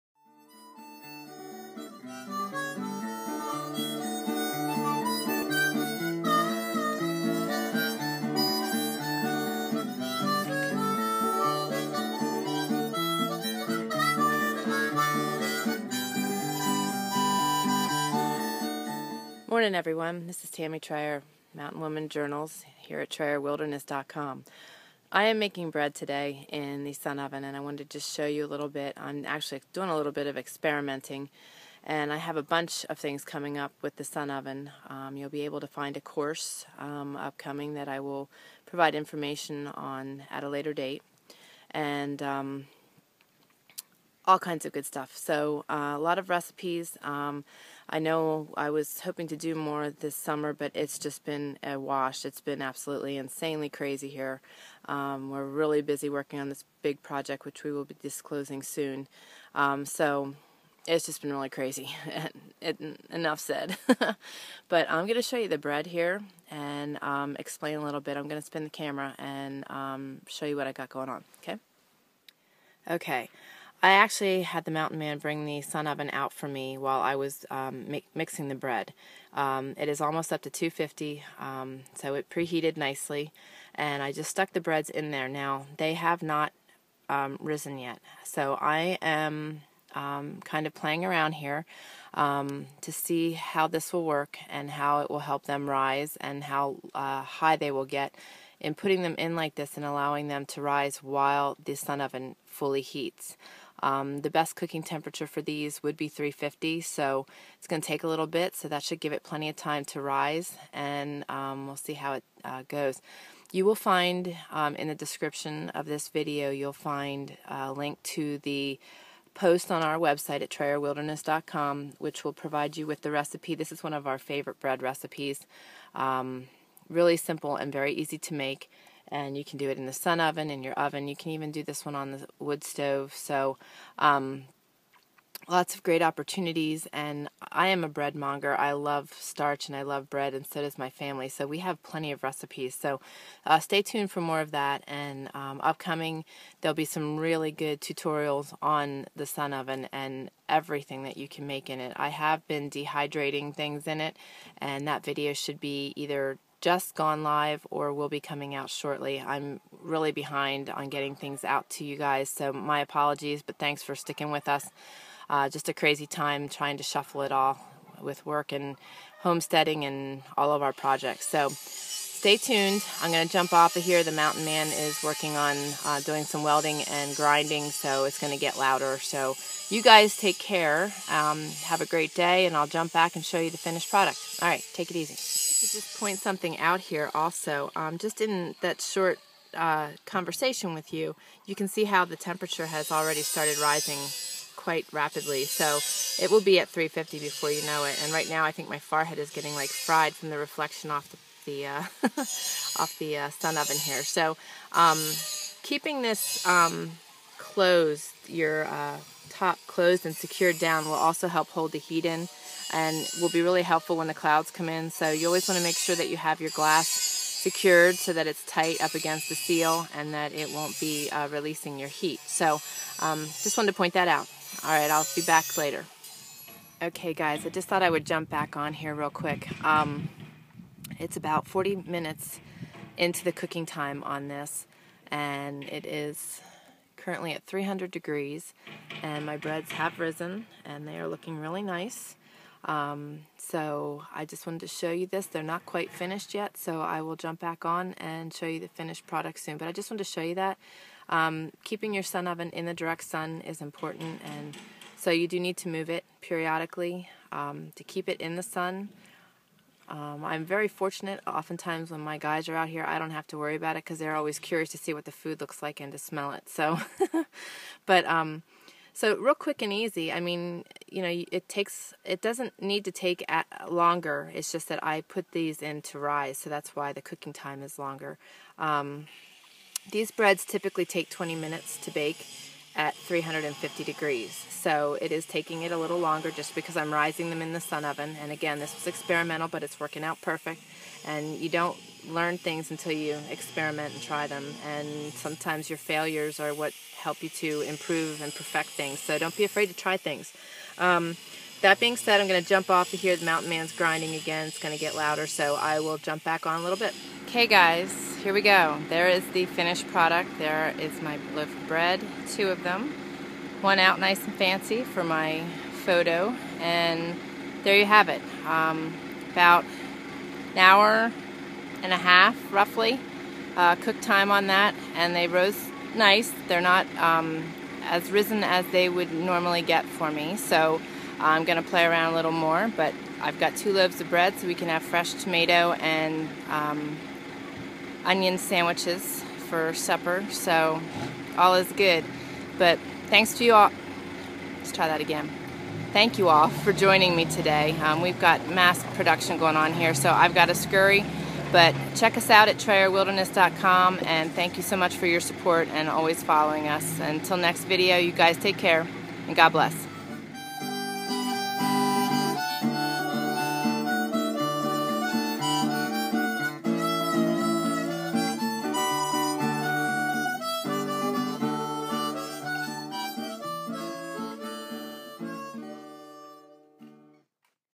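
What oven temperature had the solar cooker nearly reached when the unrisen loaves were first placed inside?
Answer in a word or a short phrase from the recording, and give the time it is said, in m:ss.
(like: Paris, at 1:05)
250, at 1:20.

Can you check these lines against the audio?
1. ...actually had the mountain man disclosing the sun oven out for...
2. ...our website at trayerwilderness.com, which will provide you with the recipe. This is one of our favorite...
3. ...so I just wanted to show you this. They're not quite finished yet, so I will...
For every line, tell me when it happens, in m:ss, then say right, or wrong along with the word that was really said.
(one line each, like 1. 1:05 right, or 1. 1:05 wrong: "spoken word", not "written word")
1. 1:13 wrong: "bring", not "disclosing"
2. 1:59 right
3. 4:03 right.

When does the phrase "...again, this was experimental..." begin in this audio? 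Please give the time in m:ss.
4:48.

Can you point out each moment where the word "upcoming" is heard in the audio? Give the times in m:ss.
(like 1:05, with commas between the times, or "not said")
0:37, 2:25.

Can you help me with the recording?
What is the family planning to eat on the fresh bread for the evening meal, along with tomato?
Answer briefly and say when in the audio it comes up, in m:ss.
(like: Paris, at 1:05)
onion sandwiches, at 5:38.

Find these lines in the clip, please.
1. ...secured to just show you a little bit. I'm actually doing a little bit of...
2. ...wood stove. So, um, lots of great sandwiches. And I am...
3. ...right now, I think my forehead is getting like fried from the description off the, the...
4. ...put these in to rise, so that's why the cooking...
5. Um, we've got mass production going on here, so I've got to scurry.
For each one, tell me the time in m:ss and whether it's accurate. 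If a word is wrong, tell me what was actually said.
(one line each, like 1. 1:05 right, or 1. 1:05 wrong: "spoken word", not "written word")
1. 0:27 wrong: "wanted", not "secured"
2. 2:12 wrong: "opportunities", not "sandwiches"
3. 3:18 wrong: "reflection", not "description"
4. 4:35 right
5. 5:47 right.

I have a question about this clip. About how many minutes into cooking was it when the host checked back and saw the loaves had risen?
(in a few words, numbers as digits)
40 minutes.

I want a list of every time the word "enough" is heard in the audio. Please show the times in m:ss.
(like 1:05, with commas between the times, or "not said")
1:03.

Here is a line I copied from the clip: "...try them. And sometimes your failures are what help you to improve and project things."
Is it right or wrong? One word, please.
wrong.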